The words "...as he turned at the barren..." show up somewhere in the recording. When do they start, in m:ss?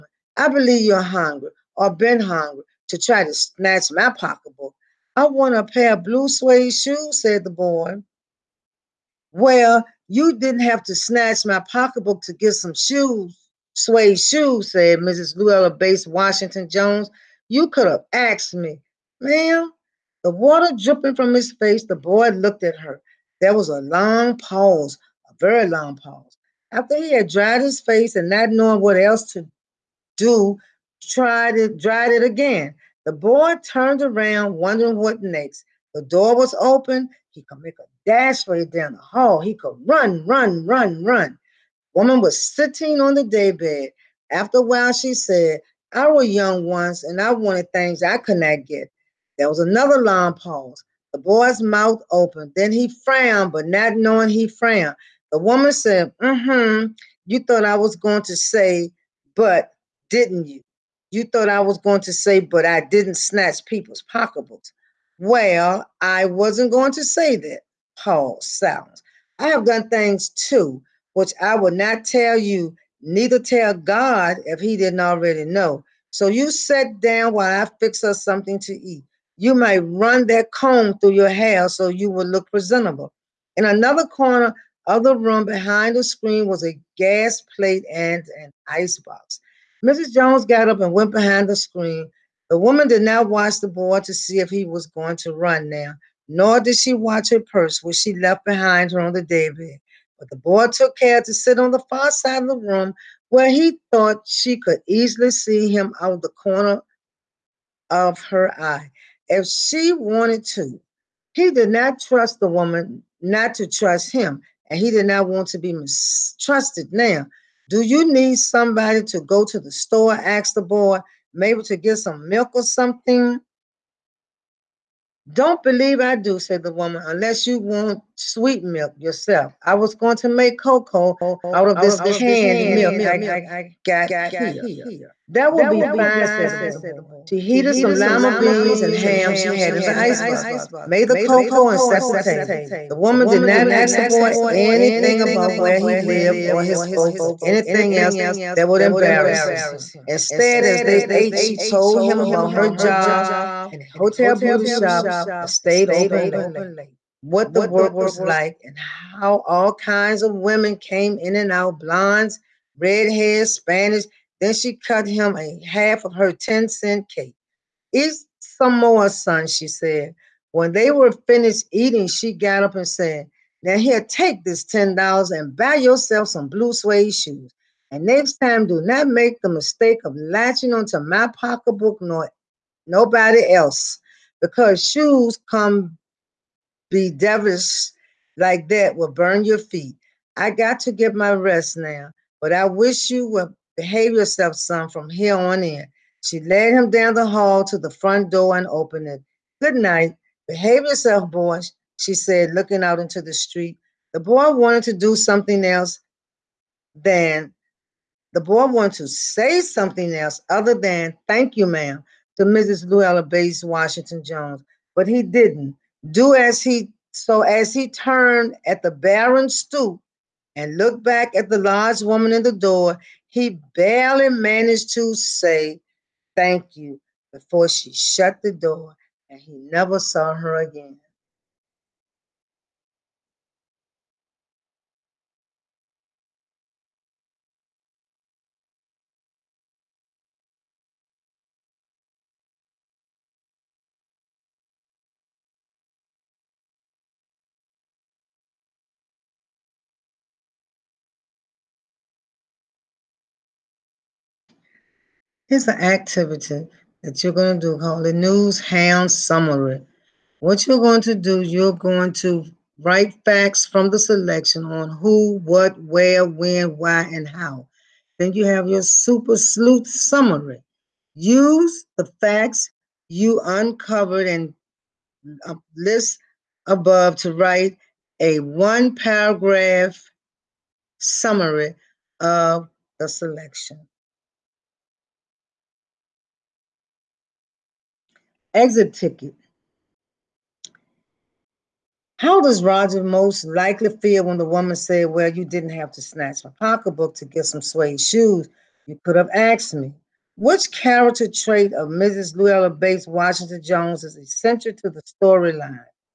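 3:37.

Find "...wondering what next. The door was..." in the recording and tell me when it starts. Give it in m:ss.
0:34.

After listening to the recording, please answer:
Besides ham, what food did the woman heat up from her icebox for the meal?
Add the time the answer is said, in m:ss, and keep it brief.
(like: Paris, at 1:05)
lima beans, at 2:17.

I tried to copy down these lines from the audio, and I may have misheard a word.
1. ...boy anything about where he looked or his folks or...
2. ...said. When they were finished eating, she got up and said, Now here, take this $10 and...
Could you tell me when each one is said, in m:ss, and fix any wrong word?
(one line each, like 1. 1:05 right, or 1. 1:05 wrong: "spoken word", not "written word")
1. 2:24 wrong: "lived", not "looked"
2. 2:49 right.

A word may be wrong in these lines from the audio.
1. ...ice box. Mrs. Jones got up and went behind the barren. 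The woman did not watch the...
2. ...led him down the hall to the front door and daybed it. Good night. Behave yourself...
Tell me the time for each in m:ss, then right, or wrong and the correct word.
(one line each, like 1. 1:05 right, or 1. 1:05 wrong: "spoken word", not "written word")
1. 1:28 wrong: "screen", not "barren"
2. 3:16 wrong: "opened", not "daybed".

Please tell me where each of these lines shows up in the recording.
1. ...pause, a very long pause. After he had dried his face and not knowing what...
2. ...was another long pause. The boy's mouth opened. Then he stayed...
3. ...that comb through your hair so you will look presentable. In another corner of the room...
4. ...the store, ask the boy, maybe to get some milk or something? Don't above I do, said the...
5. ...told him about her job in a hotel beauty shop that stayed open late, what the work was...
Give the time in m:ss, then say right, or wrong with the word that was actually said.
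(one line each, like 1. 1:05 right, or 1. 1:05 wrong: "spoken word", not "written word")
1. 0:24 right
2. 0:49 wrong: "frowned", not "stayed"
3. 1:20 right
4. 1:59 wrong: "believe", not "above"
5. 2:31 right.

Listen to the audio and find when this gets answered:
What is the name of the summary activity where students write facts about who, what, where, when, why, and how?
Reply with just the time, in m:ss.
4:18.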